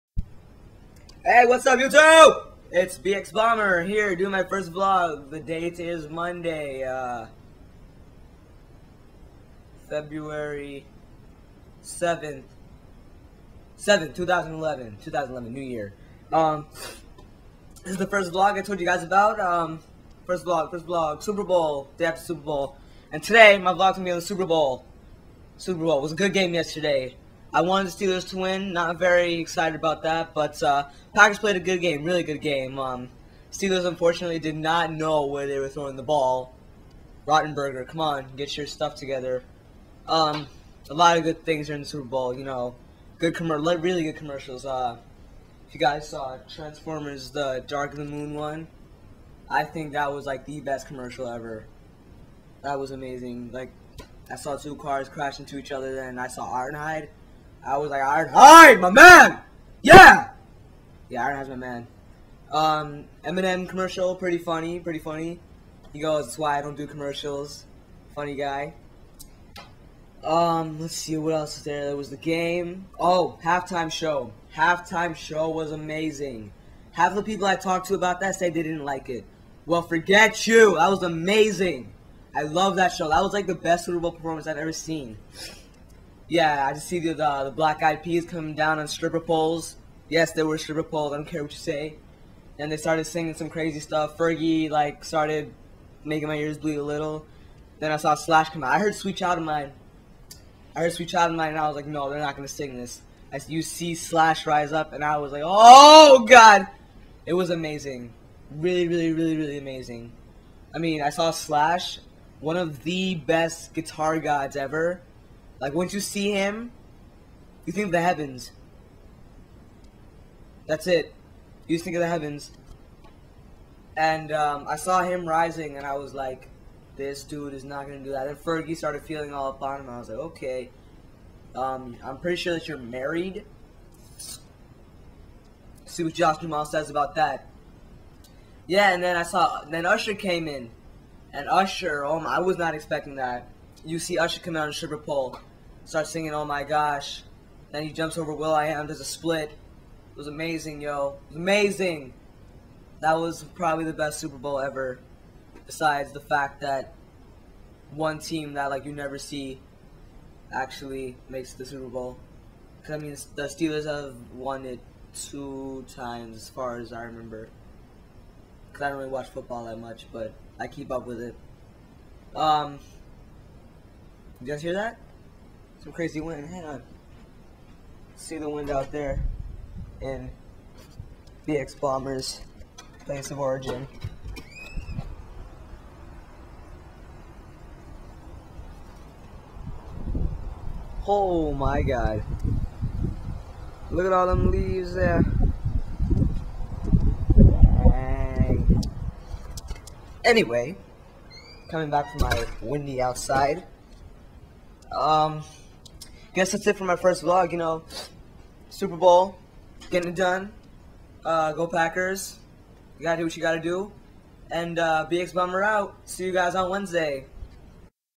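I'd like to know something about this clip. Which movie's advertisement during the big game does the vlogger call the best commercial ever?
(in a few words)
Transformers: The Dark of the Moon.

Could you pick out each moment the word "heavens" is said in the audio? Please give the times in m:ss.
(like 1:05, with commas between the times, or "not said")
1:58, 2:02.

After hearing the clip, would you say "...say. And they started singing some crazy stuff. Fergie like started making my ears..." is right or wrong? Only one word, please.
right.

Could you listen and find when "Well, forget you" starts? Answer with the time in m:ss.
1:19.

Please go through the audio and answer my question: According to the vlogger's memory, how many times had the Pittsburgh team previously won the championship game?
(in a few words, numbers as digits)
2.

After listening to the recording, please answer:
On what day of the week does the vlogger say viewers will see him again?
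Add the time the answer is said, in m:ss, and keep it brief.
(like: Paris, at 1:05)
Wednesday, at 3:36.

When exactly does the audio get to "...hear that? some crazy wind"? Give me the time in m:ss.
2:54.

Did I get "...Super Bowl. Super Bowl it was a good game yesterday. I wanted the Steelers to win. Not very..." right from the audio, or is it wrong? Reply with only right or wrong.
right.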